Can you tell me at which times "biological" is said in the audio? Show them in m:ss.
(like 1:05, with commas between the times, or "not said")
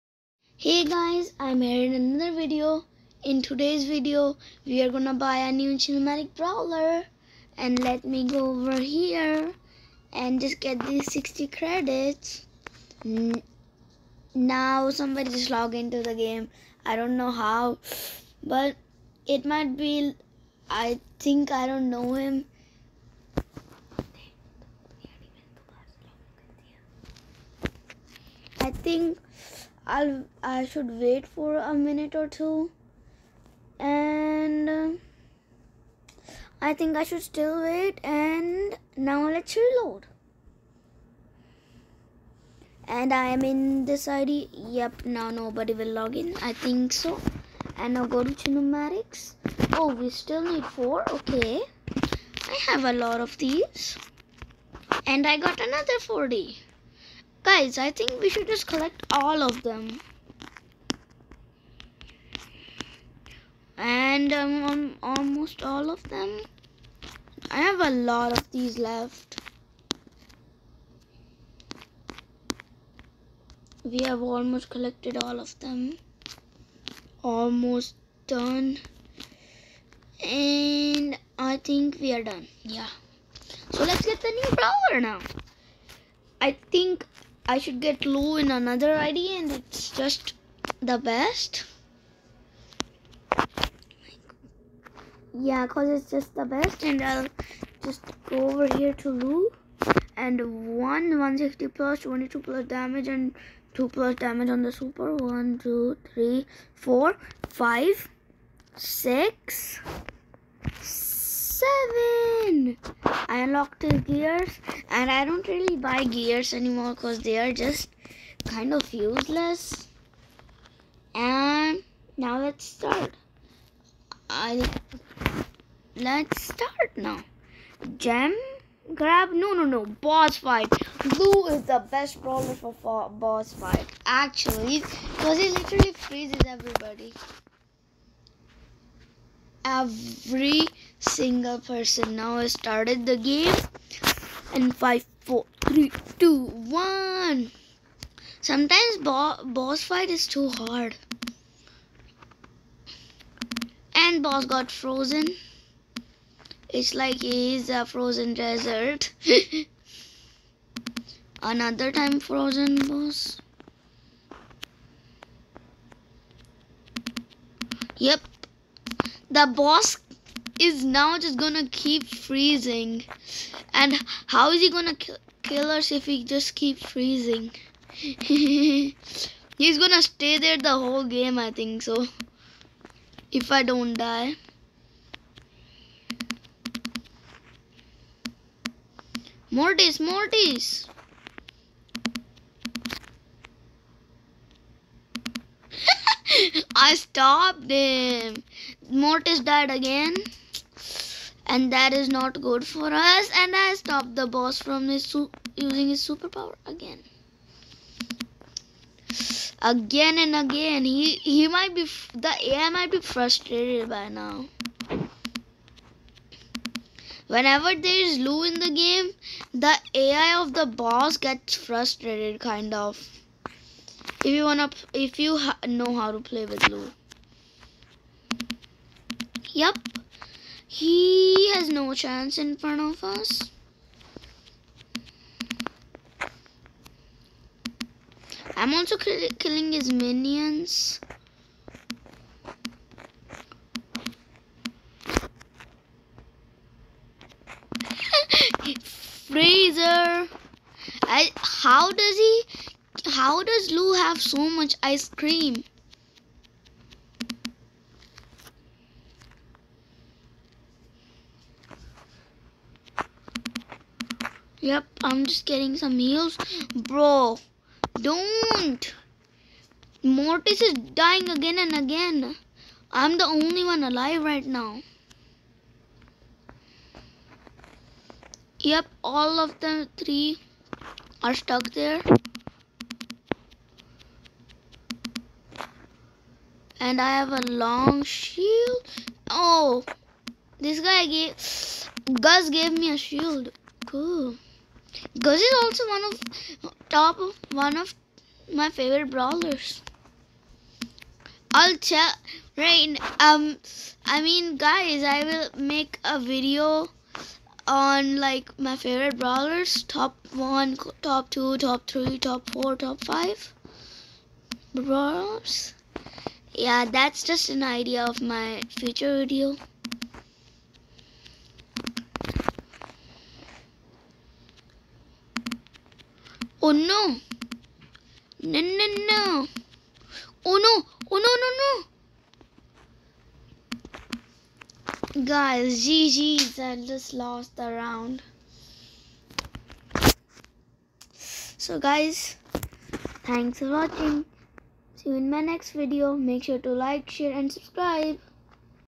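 not said.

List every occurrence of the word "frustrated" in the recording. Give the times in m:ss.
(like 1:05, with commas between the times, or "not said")
3:33, 3:41.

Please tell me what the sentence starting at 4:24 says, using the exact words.
Yep, I'm just getting some heals.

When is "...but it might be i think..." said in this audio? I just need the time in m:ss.
0:18.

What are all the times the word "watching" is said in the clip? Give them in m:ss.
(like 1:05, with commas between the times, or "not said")
5:43.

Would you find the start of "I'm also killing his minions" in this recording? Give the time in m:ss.
3:58.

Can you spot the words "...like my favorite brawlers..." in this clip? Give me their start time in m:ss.
5:08.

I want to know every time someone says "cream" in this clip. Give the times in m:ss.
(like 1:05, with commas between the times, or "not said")
4:15.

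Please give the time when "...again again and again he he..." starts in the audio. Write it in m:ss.
3:26.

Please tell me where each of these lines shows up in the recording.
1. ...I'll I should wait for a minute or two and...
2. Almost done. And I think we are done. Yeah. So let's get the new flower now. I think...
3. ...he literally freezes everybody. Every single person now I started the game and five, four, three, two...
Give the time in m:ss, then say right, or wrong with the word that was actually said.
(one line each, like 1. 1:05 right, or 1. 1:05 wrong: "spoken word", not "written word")
1. 0:29 right
2. 1:17 right
3. 2:15 right.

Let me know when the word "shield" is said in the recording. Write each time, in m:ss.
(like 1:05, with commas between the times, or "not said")
4:48, 4:52.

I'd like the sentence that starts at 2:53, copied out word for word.
And how is he gonna kill, us if he just keep freezing?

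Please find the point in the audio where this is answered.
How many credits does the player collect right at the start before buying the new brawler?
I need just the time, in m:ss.
0:11.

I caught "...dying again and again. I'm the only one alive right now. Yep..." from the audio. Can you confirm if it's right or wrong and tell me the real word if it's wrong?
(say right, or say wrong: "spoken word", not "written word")
right.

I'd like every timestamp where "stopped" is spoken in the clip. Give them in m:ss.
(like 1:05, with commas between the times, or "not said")
3:16, 3:23.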